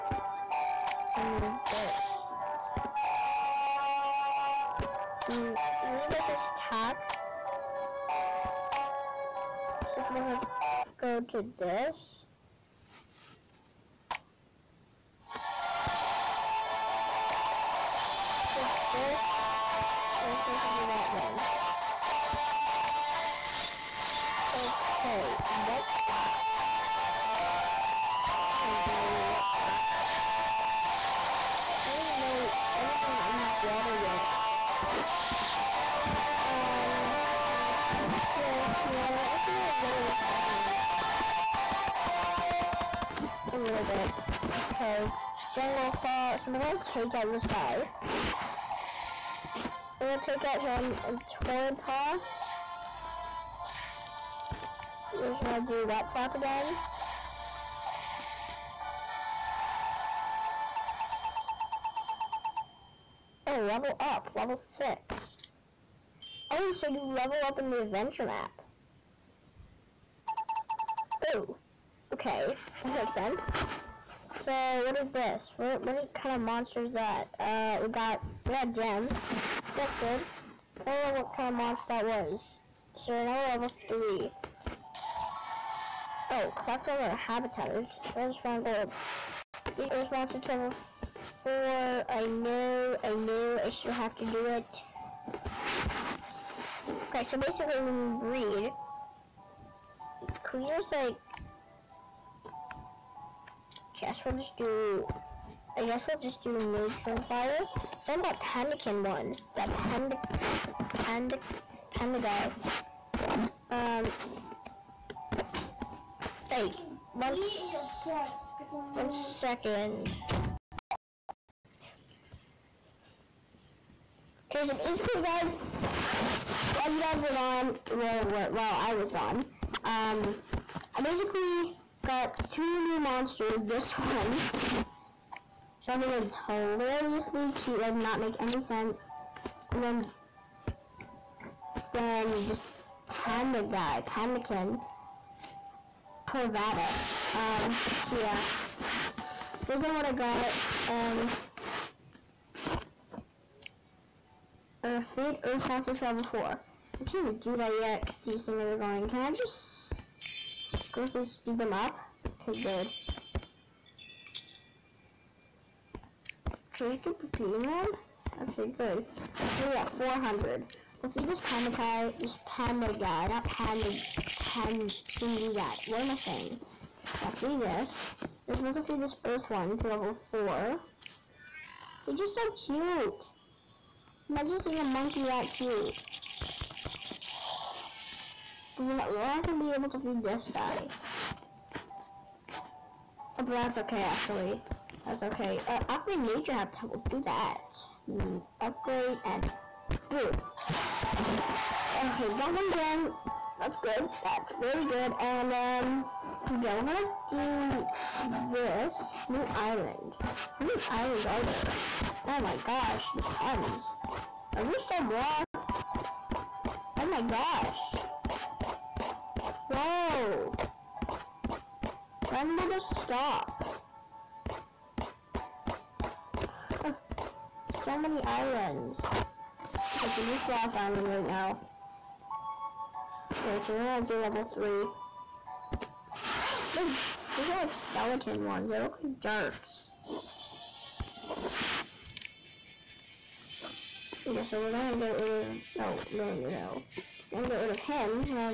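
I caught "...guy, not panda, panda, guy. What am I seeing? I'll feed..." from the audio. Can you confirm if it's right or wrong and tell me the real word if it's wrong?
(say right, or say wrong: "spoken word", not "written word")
wrong: "saying", not "seeing".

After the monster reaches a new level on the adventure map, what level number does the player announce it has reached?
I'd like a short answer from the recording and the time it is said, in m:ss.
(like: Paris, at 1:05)
6, at 1:04.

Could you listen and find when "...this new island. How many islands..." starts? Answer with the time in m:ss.
3:28.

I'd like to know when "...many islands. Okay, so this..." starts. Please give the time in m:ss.
3:47.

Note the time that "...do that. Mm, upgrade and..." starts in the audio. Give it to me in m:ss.
3:17.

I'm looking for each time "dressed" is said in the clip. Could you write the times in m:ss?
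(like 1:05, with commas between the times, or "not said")
not said.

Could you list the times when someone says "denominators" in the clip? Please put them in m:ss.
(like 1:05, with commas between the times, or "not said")
not said.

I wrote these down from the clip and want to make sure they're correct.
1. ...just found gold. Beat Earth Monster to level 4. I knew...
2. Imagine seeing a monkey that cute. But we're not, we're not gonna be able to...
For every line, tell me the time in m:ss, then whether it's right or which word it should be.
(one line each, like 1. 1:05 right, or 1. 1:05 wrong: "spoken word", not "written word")
1. 1:28 right
2. 3:04 right.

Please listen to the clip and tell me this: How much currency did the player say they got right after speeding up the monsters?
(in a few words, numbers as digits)
400.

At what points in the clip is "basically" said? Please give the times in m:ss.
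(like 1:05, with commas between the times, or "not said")
1:37, 2:04, 2:11.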